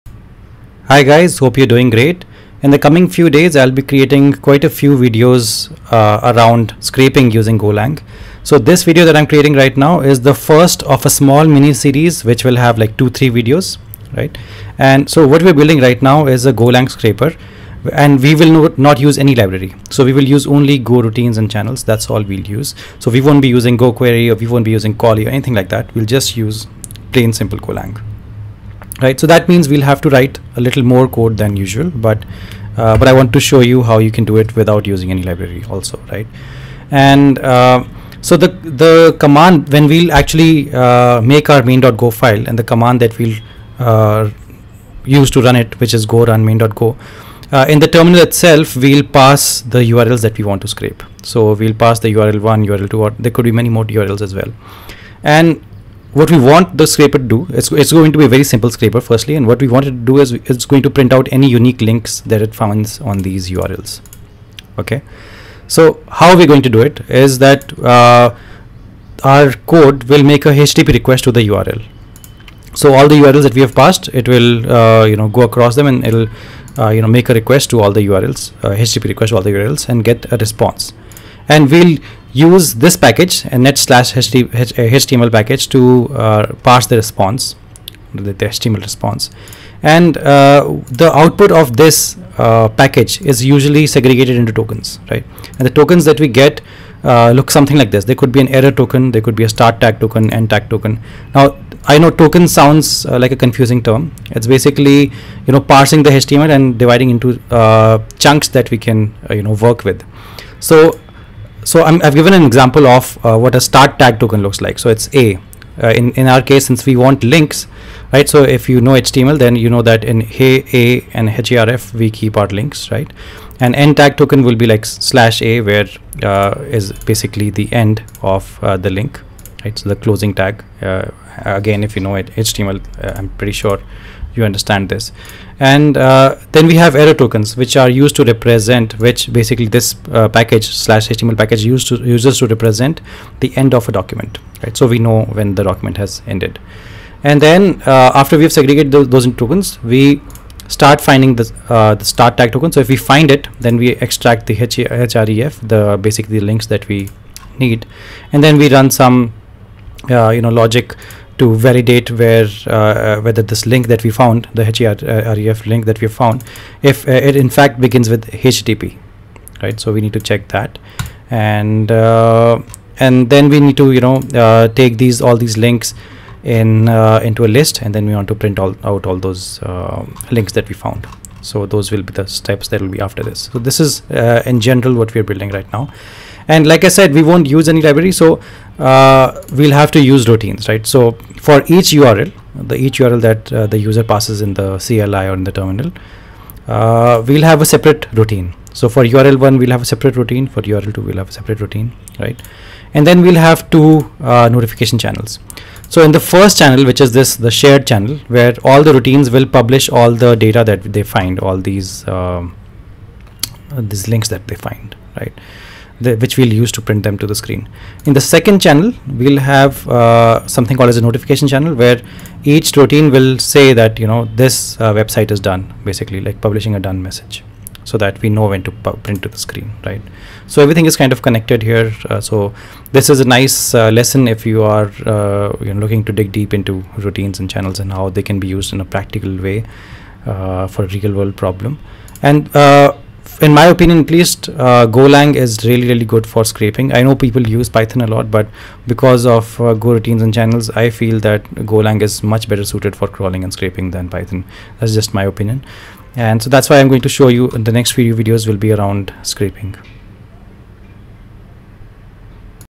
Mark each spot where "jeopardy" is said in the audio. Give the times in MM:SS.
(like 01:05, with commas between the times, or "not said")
not said.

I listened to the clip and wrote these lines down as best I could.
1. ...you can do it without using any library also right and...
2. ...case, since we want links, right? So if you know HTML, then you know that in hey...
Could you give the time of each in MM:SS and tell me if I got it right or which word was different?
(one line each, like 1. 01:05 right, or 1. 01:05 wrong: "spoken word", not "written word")
1. 00:33 right
2. 01:56 right.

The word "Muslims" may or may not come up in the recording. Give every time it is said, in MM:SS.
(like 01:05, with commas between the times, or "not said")
not said.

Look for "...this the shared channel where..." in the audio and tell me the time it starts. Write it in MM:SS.
03:27.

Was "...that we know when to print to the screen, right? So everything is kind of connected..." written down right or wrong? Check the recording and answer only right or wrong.
right.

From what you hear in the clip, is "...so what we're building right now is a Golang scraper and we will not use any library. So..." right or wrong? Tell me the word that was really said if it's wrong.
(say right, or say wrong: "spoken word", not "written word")
right.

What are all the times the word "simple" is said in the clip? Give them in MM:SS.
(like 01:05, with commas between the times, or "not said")
00:27, 00:58.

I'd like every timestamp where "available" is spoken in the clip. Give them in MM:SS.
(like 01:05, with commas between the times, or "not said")
not said.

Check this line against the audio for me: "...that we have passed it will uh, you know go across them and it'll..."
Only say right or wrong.
right.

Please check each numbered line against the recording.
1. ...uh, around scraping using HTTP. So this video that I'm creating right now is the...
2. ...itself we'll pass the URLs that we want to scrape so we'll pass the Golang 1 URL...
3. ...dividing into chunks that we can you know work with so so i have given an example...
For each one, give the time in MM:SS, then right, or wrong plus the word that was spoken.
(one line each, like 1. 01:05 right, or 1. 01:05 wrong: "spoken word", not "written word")
1. 00:05 wrong: "Golang", not "HTTP"
2. 00:48 wrong: "URL", not "Golang"
3. 01:46 right.